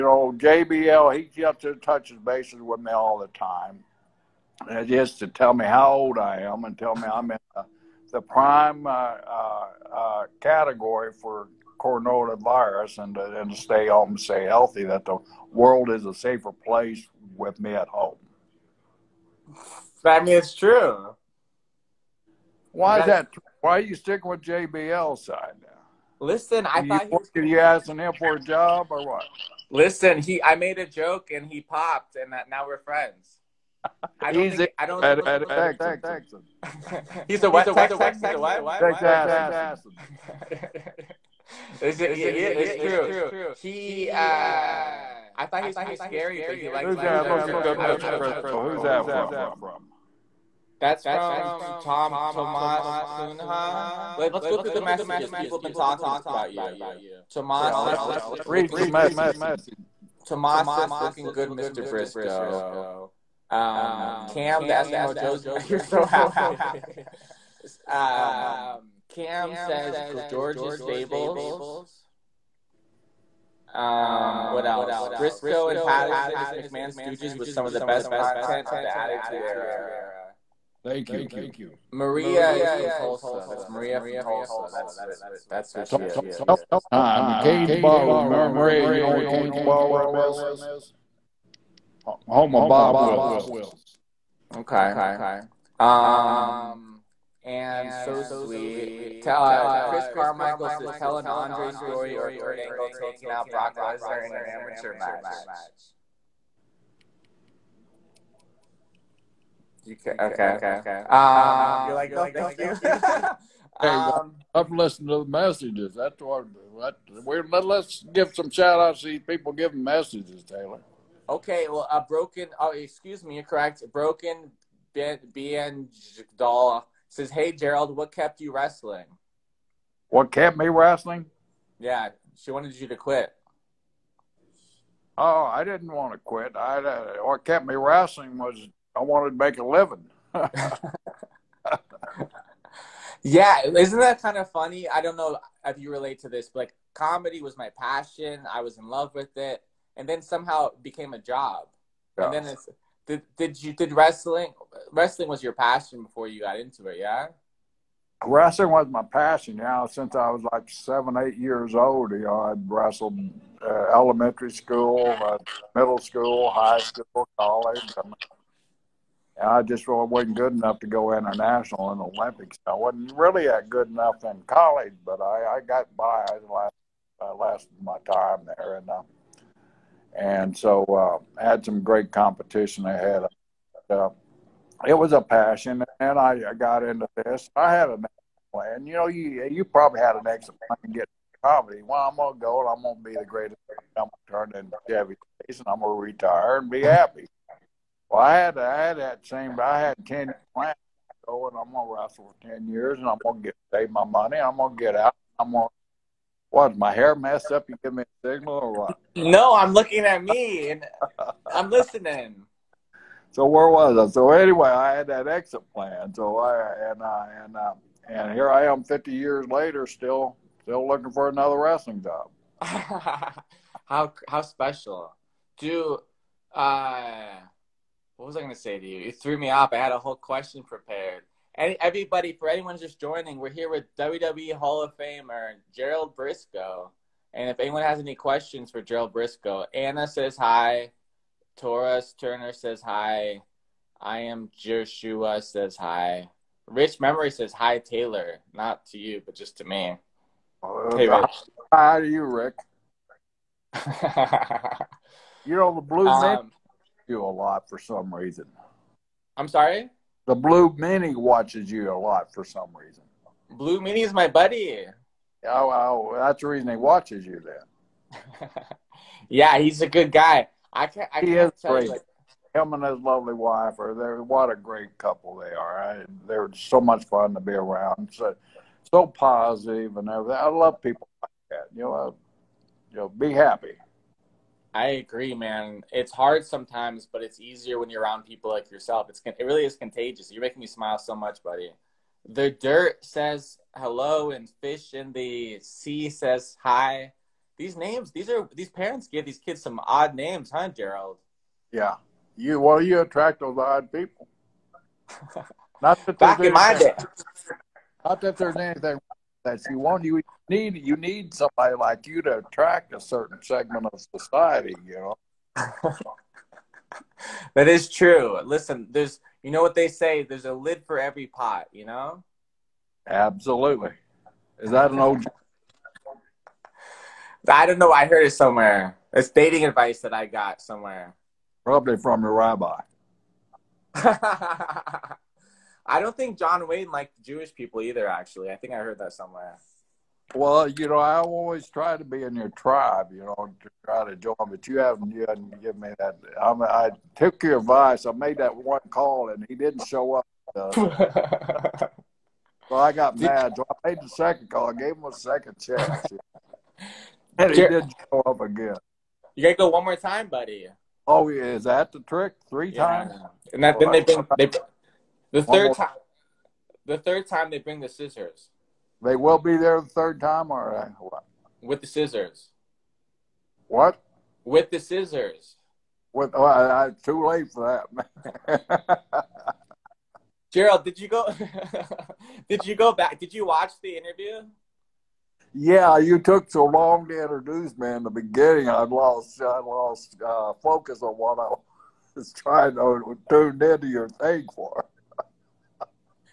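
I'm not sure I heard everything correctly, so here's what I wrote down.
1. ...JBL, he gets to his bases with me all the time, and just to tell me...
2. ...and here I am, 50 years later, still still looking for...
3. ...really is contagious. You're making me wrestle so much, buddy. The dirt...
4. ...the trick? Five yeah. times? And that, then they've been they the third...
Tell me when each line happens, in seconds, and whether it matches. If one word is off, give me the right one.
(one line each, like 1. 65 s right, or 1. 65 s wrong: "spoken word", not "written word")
1. 0 s right
2. 218 s right
3. 289 s wrong: "smile", not "wrestle"
4. 361 s wrong: "Three", not "Five".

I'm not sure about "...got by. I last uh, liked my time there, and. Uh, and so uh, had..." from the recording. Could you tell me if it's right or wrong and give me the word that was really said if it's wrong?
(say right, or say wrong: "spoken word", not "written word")
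wrong: "lasted", not "liked".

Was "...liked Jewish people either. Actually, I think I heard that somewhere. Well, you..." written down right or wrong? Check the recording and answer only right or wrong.
right.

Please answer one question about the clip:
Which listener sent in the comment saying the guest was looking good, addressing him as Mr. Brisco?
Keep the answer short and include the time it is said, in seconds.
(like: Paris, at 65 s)
Tomas Kunha, at 51 s.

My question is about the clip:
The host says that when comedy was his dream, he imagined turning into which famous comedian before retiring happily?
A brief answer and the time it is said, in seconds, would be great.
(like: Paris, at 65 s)
Chevy Chase, at 194 s.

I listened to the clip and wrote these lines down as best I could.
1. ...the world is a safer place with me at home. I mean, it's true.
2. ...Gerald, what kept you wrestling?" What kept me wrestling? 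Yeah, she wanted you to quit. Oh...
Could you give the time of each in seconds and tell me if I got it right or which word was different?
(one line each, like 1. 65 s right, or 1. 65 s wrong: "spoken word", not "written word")
1. 15 s right
2. 127 s right.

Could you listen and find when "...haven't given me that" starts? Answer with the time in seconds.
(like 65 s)
345 s.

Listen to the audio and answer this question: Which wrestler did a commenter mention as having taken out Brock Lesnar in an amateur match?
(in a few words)
Kurt Angle.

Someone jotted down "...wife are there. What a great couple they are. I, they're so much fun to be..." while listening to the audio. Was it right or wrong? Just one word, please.
right.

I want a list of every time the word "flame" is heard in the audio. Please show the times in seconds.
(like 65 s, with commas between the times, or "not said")
not said.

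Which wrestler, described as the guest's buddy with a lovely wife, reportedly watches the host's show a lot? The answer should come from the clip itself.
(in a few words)
The Blue Meanie.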